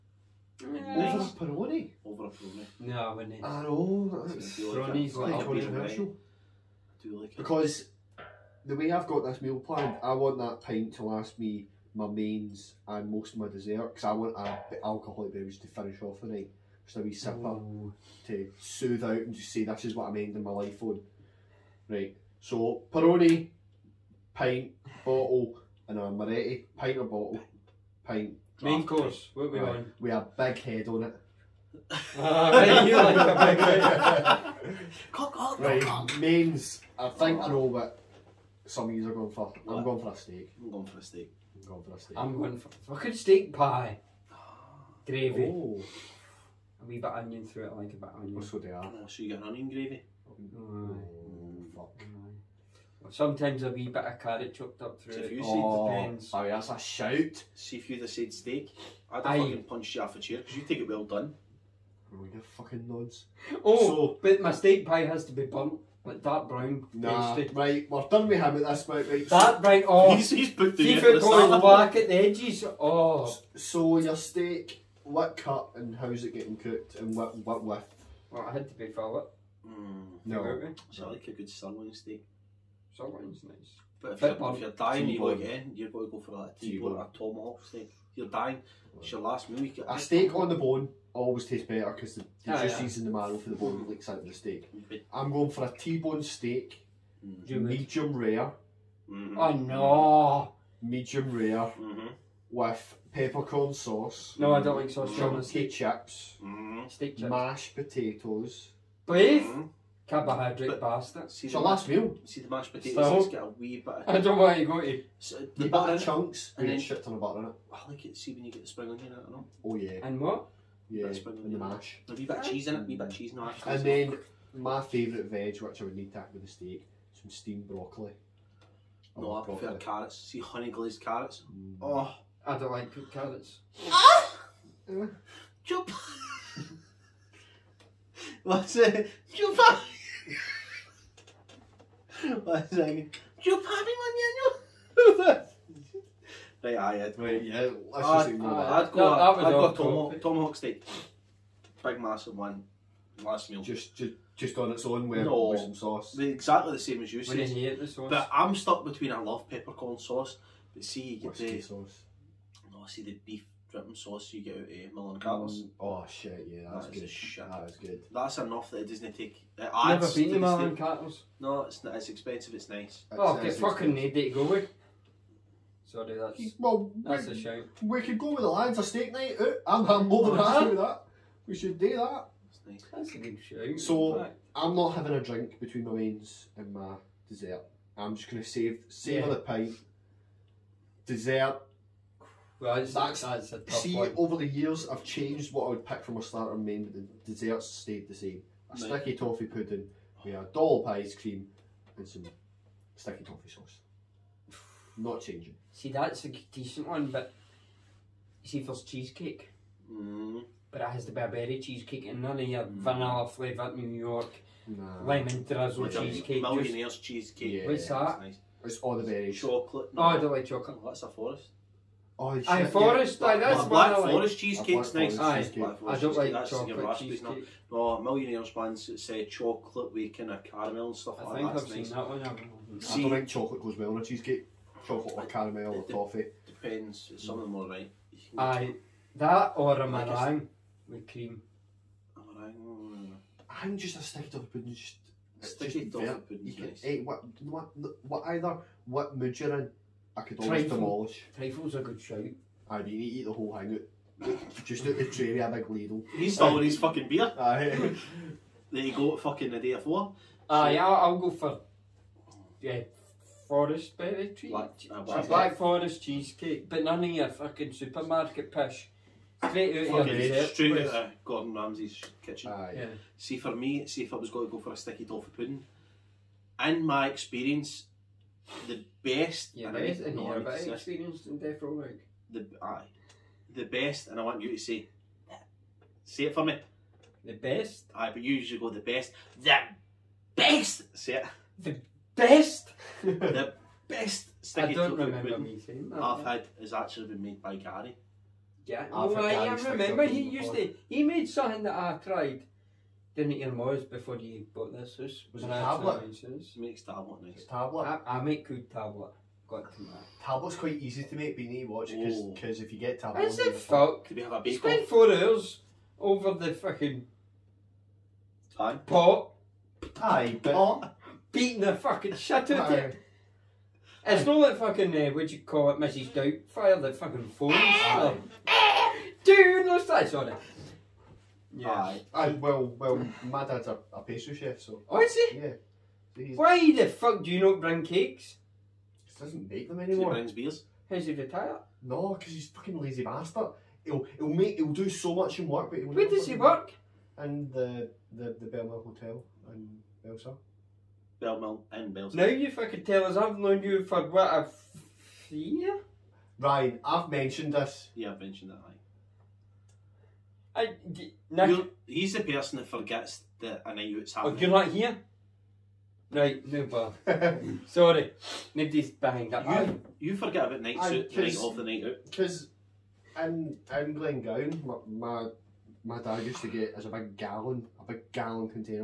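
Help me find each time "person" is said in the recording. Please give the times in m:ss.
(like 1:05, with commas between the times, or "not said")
6:02.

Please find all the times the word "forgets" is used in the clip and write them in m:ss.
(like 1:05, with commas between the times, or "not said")
6:02, 6:10.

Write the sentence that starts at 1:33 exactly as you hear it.
in the marrow for the bone leaks out of the steak.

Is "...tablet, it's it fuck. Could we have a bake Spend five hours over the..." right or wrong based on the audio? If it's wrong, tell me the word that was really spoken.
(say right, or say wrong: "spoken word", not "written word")
wrong: "four", not "five".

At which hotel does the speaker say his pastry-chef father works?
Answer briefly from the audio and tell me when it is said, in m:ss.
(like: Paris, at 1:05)
The Belmore Hotel, at 5:48.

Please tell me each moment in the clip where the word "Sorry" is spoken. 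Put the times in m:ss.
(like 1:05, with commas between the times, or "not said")
2:55, 6:07.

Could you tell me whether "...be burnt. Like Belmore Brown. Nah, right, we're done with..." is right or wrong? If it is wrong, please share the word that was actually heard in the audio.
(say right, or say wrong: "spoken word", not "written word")
wrong: "Dart", not "Belmore".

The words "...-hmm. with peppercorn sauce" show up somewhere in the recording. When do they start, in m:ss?
1:41.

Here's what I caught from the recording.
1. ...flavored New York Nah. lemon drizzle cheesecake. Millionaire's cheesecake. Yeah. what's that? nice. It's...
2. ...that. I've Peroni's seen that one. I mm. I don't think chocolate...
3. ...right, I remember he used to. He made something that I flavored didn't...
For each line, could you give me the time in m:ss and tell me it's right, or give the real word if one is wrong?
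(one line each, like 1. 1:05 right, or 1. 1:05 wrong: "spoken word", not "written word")
1. 3:33 right
2. 3:51 wrong: "That", not "Peroni"
3. 4:59 wrong: "tried", not "flavored".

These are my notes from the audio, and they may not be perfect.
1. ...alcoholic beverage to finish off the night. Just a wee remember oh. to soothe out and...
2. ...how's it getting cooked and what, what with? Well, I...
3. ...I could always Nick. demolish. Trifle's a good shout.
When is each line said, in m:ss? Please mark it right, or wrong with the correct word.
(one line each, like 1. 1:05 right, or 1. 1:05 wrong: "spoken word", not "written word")
1. 0:14 wrong: "sipper", not "remember"
2. 1:15 right
3. 4:10 wrong: "Trifle", not "Nick".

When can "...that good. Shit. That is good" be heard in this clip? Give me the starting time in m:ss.
2:46.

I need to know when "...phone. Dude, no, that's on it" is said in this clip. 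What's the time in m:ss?
5:27.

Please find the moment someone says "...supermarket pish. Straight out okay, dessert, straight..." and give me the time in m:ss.
4:27.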